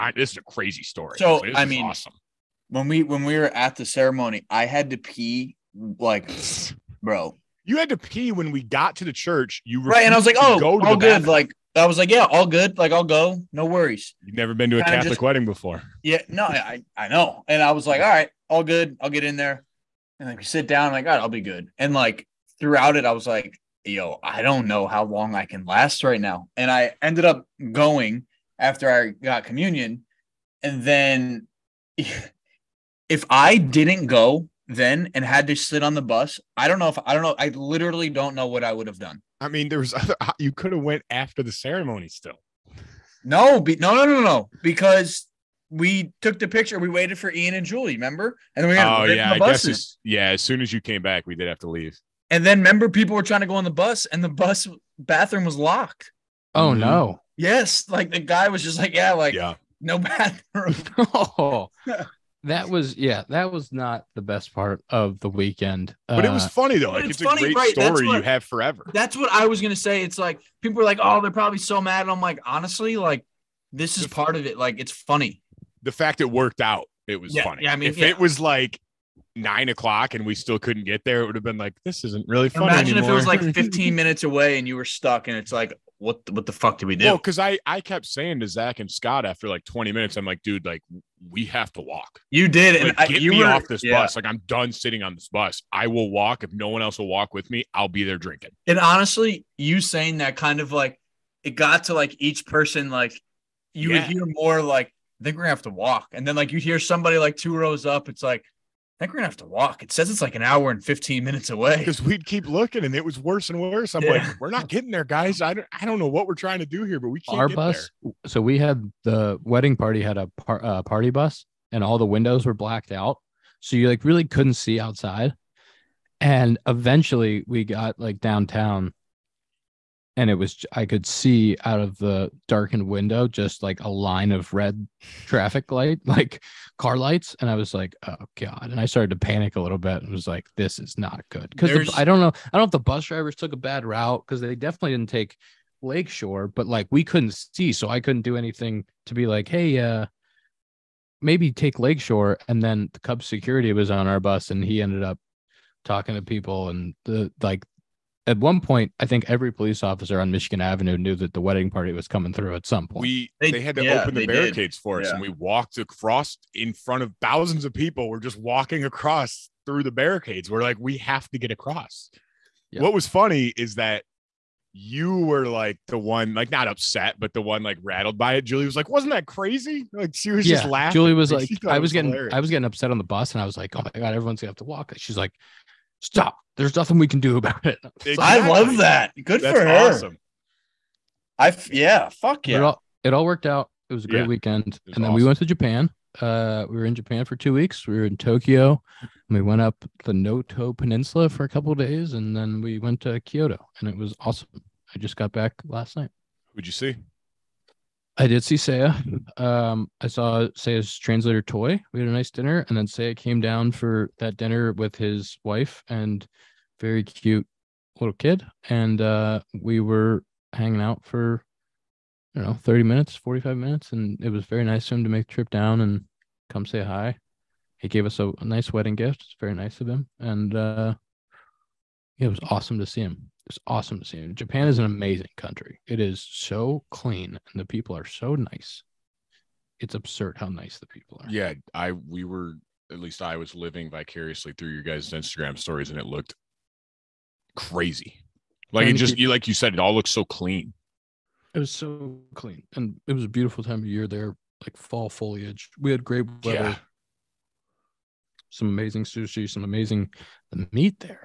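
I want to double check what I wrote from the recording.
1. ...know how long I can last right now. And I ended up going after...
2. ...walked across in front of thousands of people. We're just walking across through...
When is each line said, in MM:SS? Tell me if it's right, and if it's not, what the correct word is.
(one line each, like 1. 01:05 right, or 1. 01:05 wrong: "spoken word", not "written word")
1. 00:24 right
2. 02:45 right.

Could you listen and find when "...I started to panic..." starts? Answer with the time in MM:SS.
02:18.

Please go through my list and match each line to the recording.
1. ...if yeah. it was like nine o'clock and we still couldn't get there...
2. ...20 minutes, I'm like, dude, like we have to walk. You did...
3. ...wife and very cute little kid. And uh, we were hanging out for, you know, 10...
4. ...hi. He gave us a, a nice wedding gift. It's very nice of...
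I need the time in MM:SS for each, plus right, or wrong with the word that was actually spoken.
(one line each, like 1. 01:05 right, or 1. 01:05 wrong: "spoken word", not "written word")
1. 01:17 right
2. 01:29 right
3. 03:35 wrong: "30", not "10"
4. 03:46 right.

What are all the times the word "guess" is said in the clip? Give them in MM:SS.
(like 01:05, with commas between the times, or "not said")
00:49.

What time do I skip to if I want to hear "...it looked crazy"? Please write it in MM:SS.
04:05.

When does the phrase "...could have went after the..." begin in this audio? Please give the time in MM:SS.
00:40.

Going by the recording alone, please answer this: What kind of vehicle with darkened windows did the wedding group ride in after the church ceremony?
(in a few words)
party bus.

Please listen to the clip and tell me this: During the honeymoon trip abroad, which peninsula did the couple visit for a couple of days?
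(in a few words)
Noto Peninsula.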